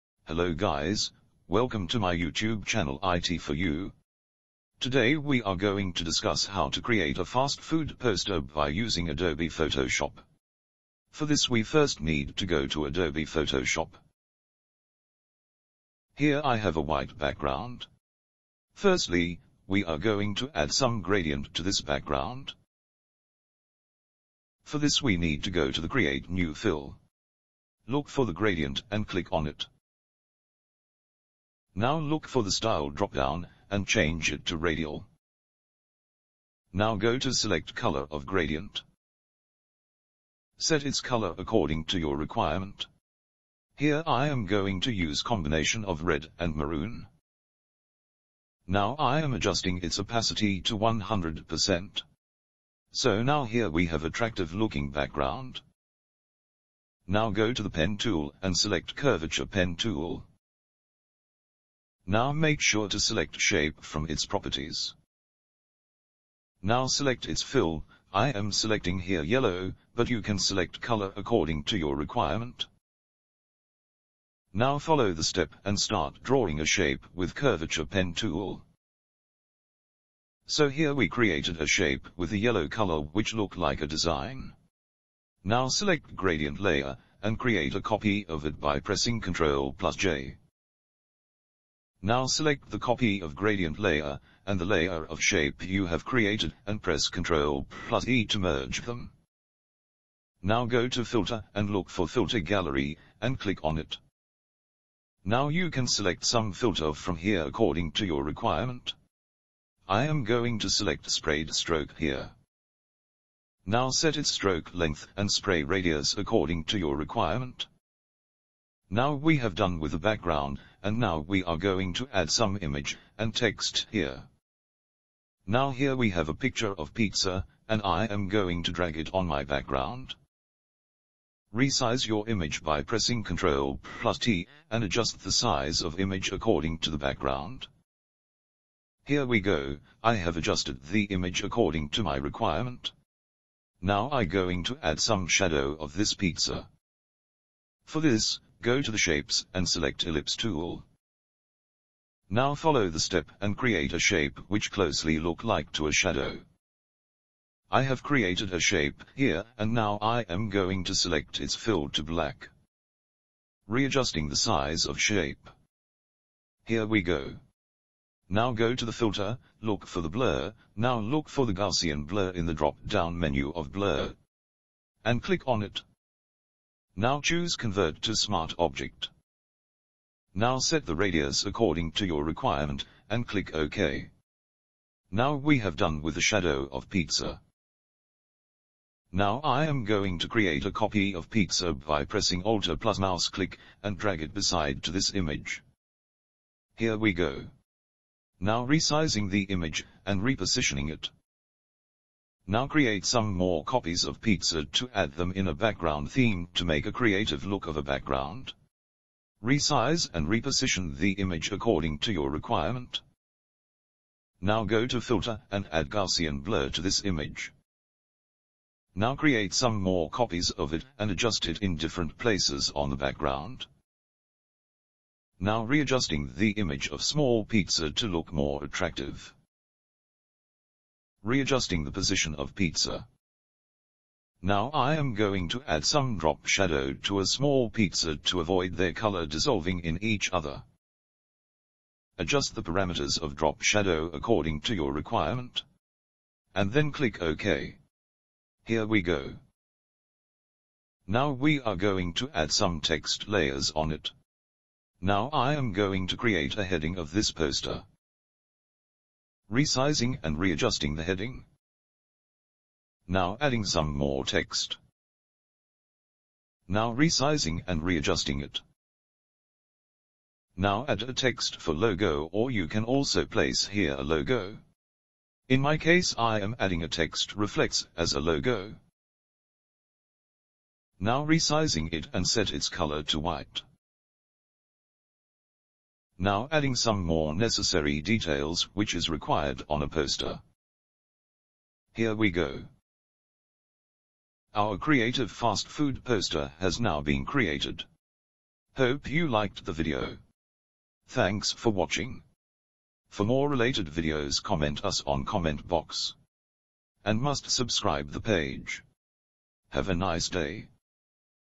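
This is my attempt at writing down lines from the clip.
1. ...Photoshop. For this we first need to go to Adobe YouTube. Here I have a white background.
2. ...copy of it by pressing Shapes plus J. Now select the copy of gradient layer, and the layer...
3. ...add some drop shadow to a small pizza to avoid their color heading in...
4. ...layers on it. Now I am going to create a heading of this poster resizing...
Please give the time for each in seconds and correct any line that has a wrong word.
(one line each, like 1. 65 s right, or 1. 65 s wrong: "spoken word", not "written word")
1. 9 s wrong: "Photoshop", not "YouTube"
2. 87 s wrong: "Ctrl", not "Shapes"
3. 235 s wrong: "dissolving", not "heading"
4. 253 s right.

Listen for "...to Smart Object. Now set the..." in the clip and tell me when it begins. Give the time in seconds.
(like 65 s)
178 s.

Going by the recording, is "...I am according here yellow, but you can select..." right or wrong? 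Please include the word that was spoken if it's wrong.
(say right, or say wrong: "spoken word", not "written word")
wrong: "selecting", not "according".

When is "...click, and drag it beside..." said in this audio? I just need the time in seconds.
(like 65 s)
193 s.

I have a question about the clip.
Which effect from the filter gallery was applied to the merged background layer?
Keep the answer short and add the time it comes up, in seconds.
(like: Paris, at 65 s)
sprayed stroke, at 111 s.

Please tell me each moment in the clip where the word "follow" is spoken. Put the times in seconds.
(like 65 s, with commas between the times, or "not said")
74 s, 152 s.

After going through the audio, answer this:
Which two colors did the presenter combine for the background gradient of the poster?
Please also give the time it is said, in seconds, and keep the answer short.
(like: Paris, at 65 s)
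red and maroon, at 46 s.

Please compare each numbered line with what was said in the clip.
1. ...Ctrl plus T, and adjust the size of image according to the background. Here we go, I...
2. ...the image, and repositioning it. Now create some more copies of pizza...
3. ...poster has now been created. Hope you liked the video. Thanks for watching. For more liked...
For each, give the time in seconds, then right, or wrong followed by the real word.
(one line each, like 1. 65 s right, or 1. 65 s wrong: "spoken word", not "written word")
1. 133 s right
2. 199 s right
3. 296 s wrong: "related", not "liked".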